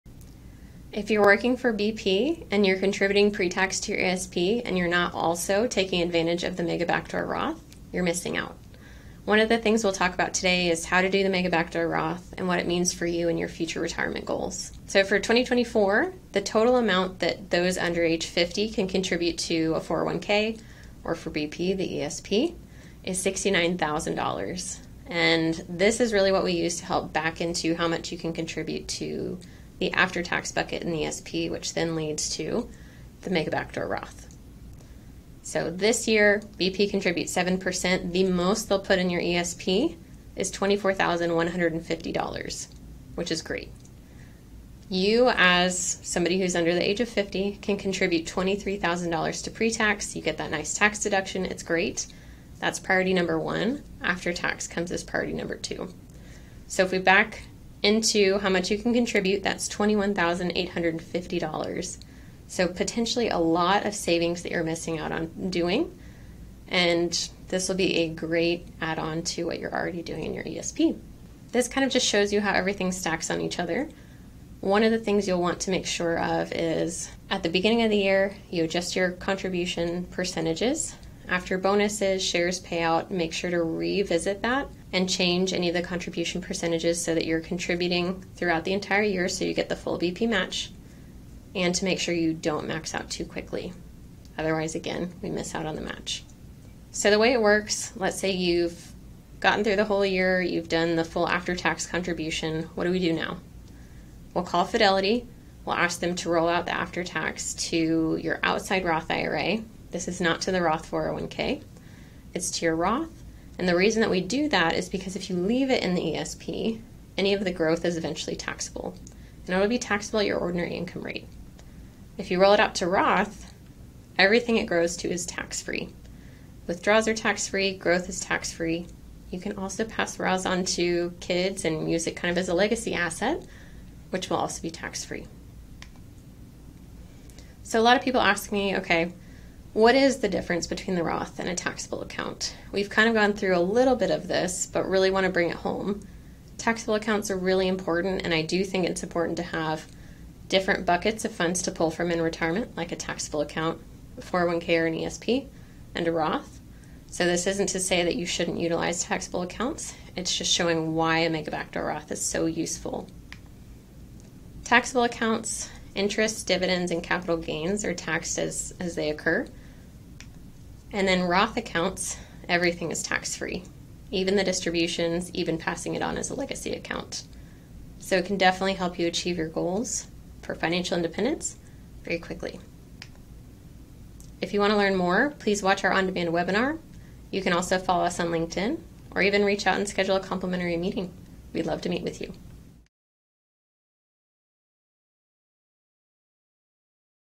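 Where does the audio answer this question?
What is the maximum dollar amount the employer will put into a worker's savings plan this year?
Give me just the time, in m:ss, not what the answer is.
0:40.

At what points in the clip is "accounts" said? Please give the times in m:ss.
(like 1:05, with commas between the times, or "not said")
2:22, 2:26, 2:33, 2:39, 2:45, 2:51, 2:56.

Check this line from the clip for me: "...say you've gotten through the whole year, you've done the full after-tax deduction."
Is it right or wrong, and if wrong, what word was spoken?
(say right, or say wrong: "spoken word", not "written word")
wrong: "contribution", not "deduction".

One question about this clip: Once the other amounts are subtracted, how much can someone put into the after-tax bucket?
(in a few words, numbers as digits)
$21,850.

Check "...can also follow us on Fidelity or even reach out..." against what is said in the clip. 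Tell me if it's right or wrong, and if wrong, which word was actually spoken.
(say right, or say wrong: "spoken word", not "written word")
wrong: "LinkedIn", not "Fidelity".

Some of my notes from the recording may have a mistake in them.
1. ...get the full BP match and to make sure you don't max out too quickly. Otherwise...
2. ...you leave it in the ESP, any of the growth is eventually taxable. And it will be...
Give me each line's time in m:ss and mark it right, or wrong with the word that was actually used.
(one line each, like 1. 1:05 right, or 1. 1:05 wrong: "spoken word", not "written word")
1. 1:29 right
2. 1:55 right.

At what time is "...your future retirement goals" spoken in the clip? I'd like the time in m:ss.
0:13.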